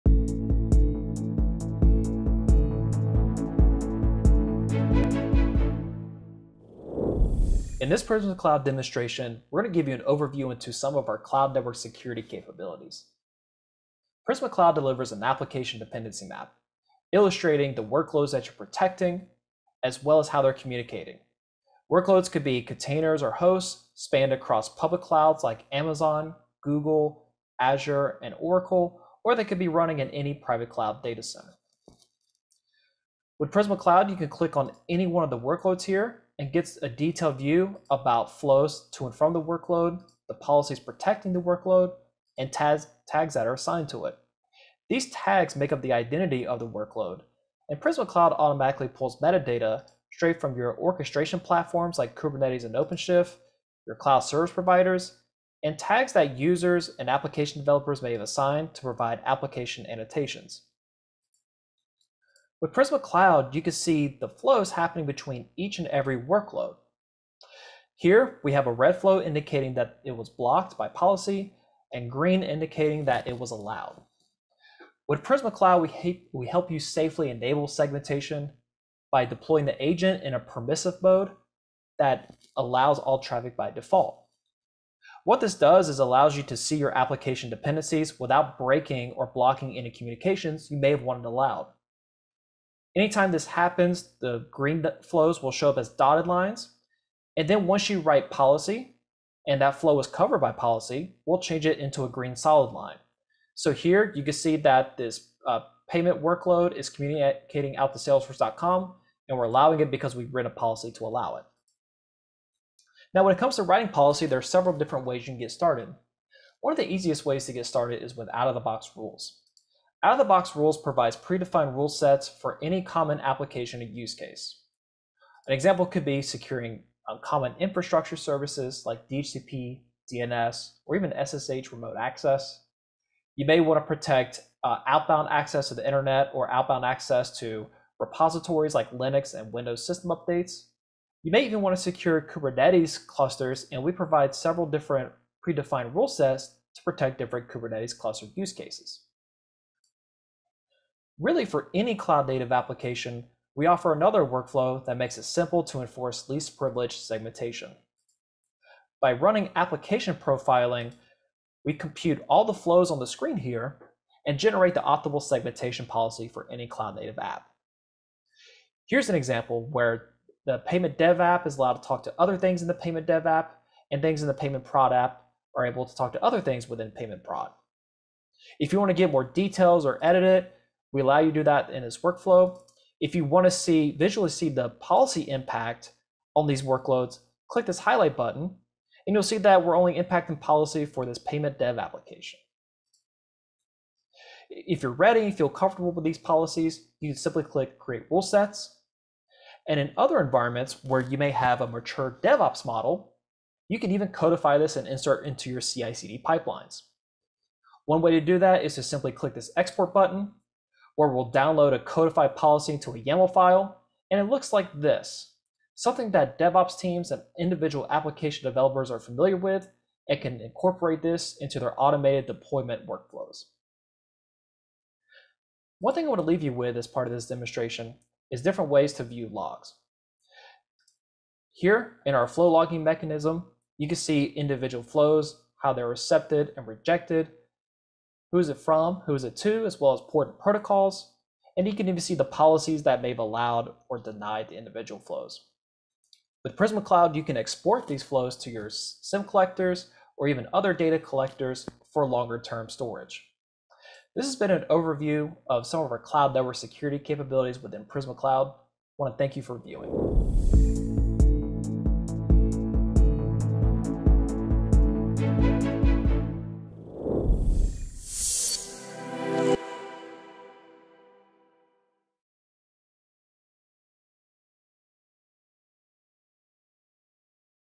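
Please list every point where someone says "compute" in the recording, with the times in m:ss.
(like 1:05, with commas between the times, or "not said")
2:41.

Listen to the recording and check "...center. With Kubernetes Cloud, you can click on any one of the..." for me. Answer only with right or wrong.
wrong.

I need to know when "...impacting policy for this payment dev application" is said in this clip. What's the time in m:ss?
3:09.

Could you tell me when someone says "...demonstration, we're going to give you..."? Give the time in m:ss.
0:08.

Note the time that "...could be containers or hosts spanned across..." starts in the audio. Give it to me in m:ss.
0:22.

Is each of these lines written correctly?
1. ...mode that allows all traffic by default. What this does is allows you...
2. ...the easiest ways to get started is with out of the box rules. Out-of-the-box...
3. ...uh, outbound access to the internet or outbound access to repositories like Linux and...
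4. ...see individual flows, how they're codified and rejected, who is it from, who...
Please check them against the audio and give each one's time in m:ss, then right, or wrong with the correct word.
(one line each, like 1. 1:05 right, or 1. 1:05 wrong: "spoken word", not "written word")
1. 1:21 right
2. 1:56 right
3. 2:14 right
4. 3:53 wrong: "accepted", not "codified".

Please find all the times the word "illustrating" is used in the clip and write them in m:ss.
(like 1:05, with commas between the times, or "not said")
0:17.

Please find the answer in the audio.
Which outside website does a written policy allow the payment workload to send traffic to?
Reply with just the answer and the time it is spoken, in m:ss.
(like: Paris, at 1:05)
salesforce.com, at 1:47.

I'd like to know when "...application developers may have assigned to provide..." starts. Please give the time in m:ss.
0:57.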